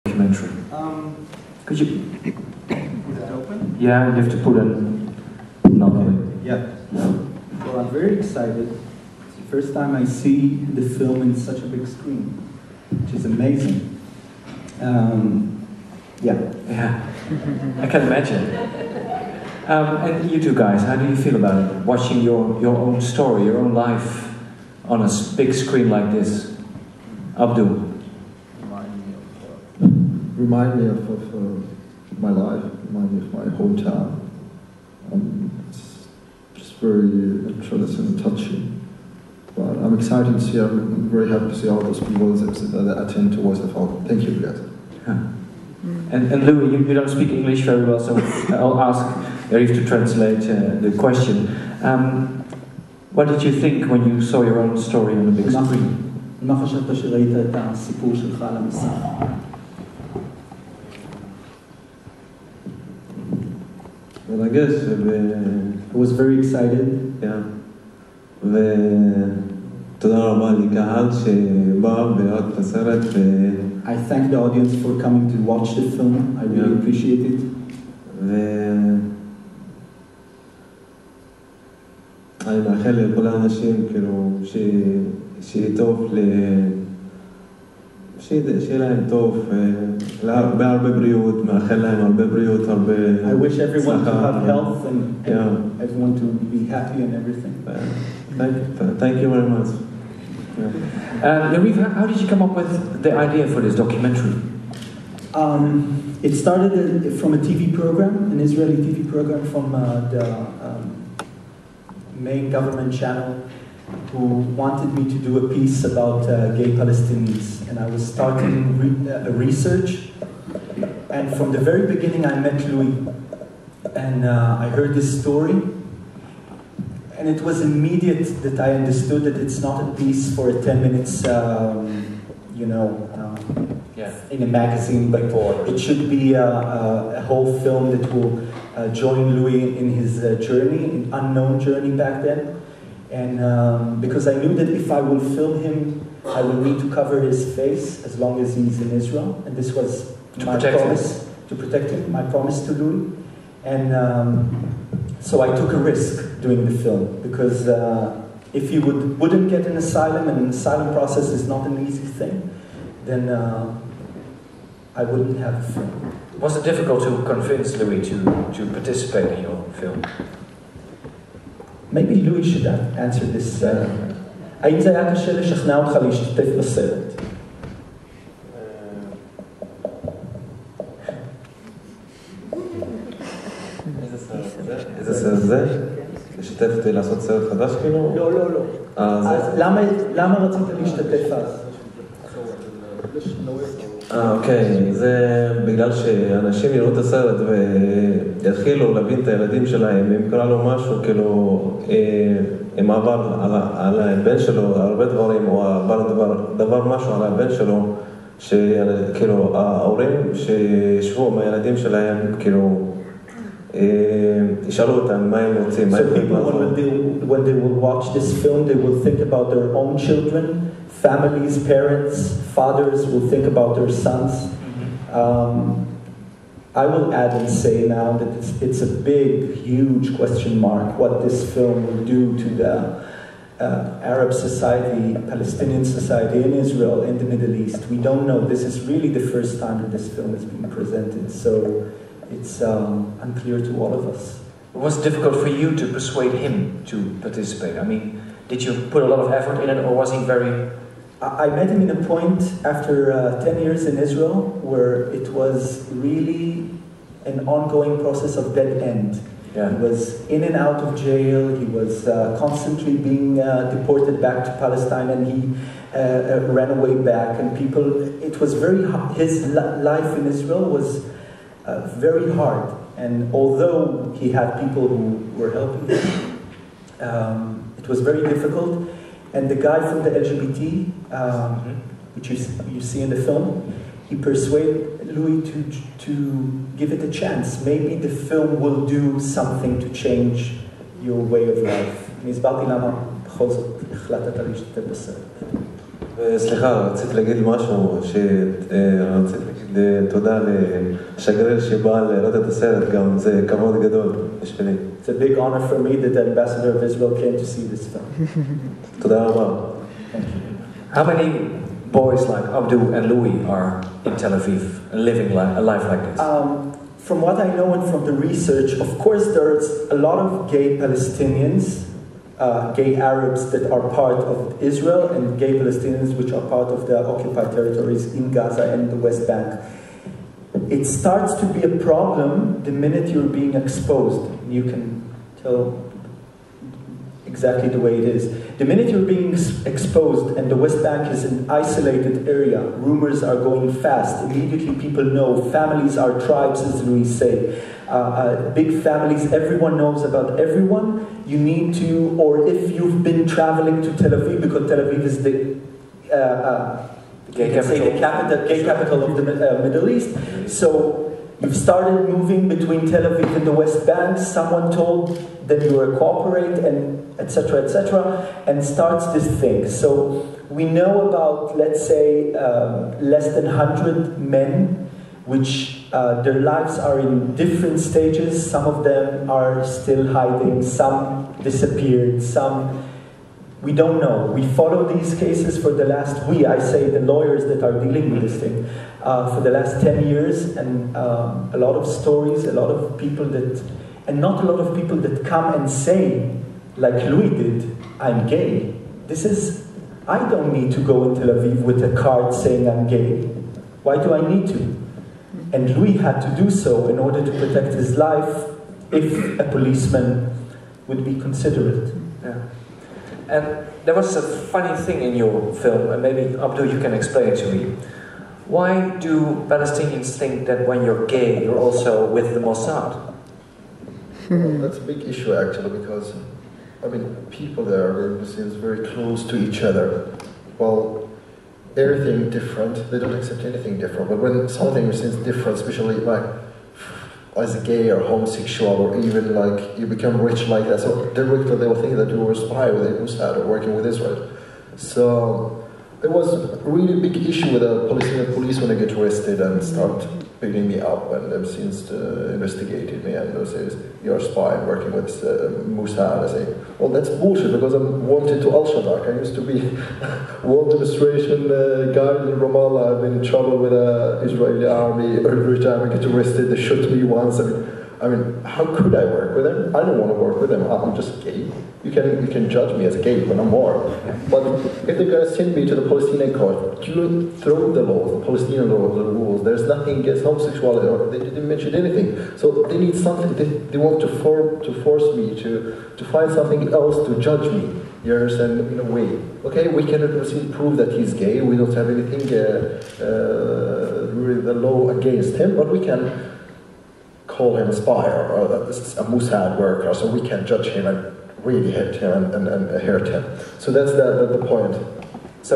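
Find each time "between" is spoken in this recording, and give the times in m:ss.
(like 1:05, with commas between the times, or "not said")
6:02.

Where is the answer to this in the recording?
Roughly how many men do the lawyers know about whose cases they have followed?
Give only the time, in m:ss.
6:13.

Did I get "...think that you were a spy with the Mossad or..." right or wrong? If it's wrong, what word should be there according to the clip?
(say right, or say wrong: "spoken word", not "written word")
right.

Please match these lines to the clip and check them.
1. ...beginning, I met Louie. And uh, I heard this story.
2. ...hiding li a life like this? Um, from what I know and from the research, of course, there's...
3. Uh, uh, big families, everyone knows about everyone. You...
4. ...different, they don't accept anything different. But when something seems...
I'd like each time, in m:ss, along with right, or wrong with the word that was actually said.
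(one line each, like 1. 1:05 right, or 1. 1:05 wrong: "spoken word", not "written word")
1. 2:01 right
2. 5:14 wrong: "living", not "hiding"
3. 5:47 right
4. 7:12 right.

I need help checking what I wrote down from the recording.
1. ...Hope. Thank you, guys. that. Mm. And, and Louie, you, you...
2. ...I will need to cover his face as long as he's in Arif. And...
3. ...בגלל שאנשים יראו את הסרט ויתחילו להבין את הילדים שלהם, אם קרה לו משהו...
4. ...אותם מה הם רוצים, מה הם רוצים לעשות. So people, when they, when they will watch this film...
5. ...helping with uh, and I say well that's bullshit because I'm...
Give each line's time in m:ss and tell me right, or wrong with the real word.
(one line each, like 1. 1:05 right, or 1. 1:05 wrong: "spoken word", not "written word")
1. 0:43 right
2. 2:26 wrong: "Israel", not "Arif"
3. 3:15 right
4. 3:34 right
5. 7:34 wrong: "working", not "helping".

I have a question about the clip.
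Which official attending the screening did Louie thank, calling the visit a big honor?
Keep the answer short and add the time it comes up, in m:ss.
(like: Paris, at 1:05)
The ambassador of Israel, at 5:06.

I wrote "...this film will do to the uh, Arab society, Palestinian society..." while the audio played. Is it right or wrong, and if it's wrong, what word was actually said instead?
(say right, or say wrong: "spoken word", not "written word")
right.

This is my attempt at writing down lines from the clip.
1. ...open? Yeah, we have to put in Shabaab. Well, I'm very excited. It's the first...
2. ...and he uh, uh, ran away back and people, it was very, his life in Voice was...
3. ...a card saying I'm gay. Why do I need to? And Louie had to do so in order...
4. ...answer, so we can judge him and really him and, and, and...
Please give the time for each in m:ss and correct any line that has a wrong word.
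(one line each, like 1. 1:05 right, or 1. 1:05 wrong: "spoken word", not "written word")
1. 0:03 wrong: "Yeah", not "Shabaab"
2. 4:25 wrong: "Israel", not "Voice"
3. 6:41 right
4. 8:19 wrong: "worker", not "answer".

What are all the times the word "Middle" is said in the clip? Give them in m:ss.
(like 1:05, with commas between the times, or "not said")
3:57, 5:59.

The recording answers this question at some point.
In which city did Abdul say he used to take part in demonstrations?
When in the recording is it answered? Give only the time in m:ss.
7:42.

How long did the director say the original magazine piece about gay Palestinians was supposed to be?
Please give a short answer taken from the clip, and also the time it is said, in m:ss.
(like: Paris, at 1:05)
10 minutes, at 2:10.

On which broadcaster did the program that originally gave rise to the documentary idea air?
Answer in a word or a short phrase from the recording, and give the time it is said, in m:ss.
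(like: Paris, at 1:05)
Israeli TV, at 1:48.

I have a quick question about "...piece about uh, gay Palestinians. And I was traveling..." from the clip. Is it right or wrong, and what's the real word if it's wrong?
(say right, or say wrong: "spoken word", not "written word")
wrong: "starting", not "traveling".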